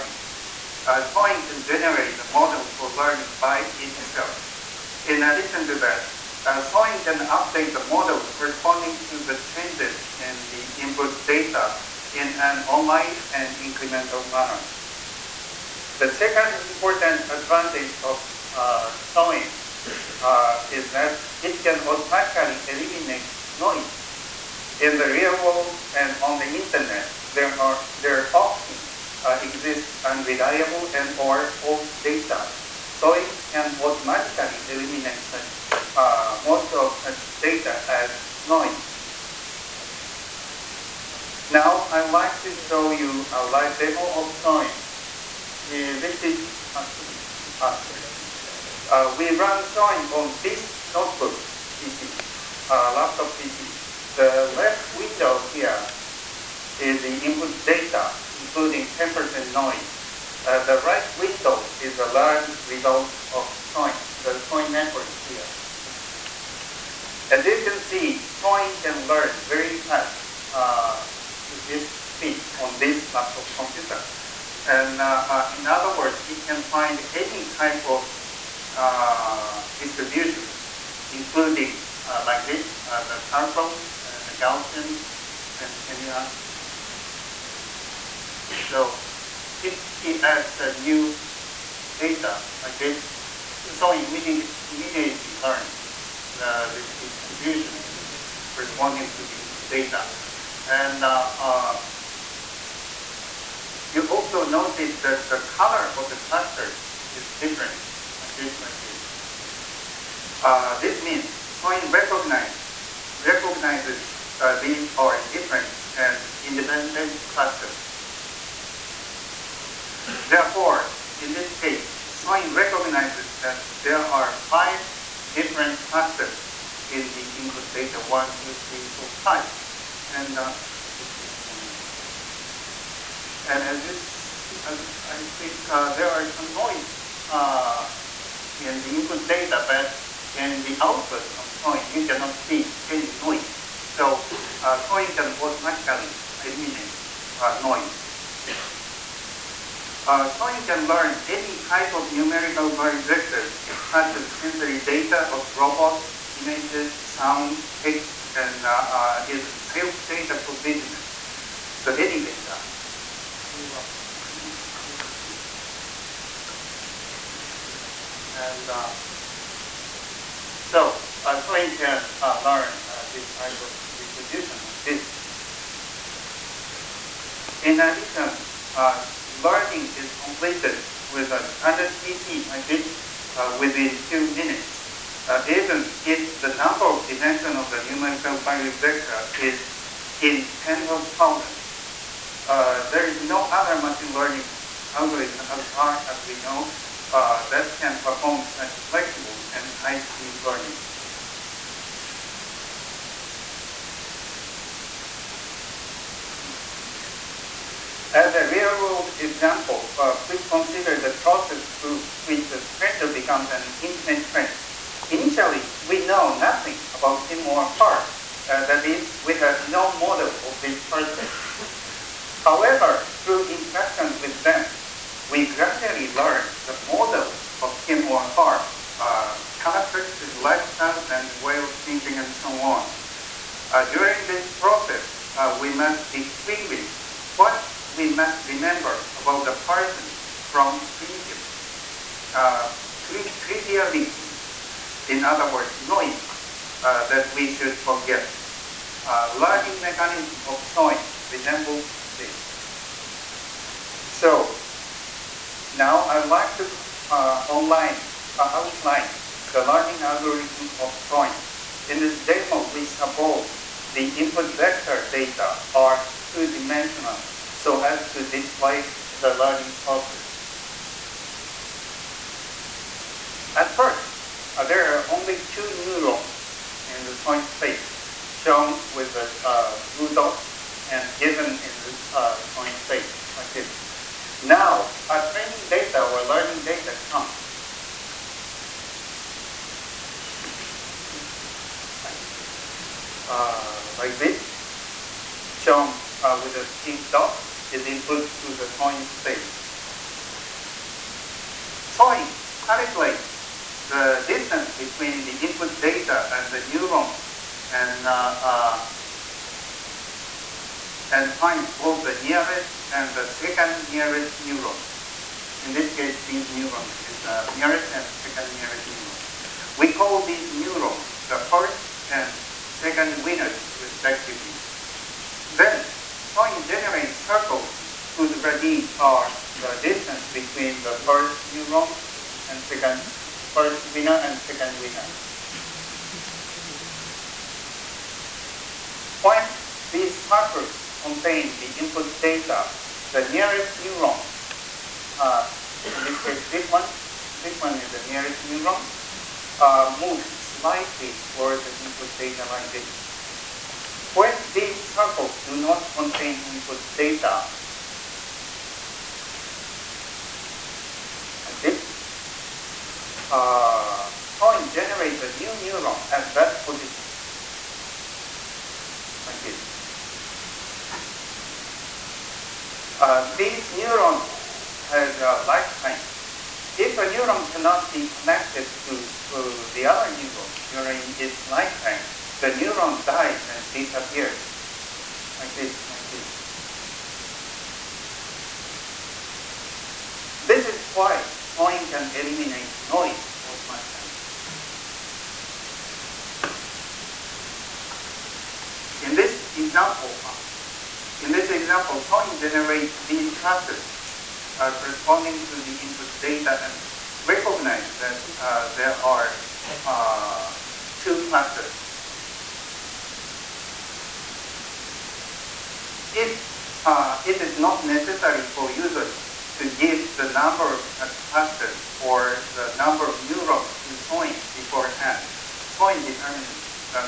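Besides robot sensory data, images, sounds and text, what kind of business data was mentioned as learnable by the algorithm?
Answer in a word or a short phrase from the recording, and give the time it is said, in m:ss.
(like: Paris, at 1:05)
sales data, at 2:39.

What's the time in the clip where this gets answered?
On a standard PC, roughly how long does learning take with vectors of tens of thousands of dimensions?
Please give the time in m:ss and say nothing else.
3:03.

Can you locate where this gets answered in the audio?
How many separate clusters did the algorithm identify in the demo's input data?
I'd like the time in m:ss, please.
2:04.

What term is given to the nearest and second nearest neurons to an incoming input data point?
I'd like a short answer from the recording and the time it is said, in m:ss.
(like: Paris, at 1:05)
first and second winners, at 5:21.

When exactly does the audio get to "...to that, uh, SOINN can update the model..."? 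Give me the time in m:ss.
0:05.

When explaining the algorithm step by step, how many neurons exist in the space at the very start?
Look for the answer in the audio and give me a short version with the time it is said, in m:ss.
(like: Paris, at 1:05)
2, at 4:35.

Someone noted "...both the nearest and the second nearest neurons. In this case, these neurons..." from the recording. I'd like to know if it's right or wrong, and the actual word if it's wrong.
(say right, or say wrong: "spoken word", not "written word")
right.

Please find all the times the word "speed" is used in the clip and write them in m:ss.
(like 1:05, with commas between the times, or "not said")
1:12, 3:19.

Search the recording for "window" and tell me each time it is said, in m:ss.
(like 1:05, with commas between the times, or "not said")
0:54, 1:01.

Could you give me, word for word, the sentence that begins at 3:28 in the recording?
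As a real-world example, uh, please consider the process through which a stranger becomes an intimate friend.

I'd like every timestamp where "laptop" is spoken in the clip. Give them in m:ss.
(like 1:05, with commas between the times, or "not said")
0:52, 1:13.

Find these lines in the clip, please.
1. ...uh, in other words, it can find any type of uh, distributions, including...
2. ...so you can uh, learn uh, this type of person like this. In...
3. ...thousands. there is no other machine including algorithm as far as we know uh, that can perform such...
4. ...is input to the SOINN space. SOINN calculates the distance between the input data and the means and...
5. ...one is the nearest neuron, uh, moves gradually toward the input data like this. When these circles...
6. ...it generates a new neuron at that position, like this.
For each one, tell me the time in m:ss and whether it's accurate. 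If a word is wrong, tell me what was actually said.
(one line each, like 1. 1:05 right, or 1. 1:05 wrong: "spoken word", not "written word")
1. 1:15 right
2. 2:51 wrong: "distribution", not "person"
3. 3:11 wrong: "learning", not "including"
4. 4:57 wrong: "neurons", not "means"
5. 5:47 wrong: "slightly", not "gradually"
6. 6:04 right.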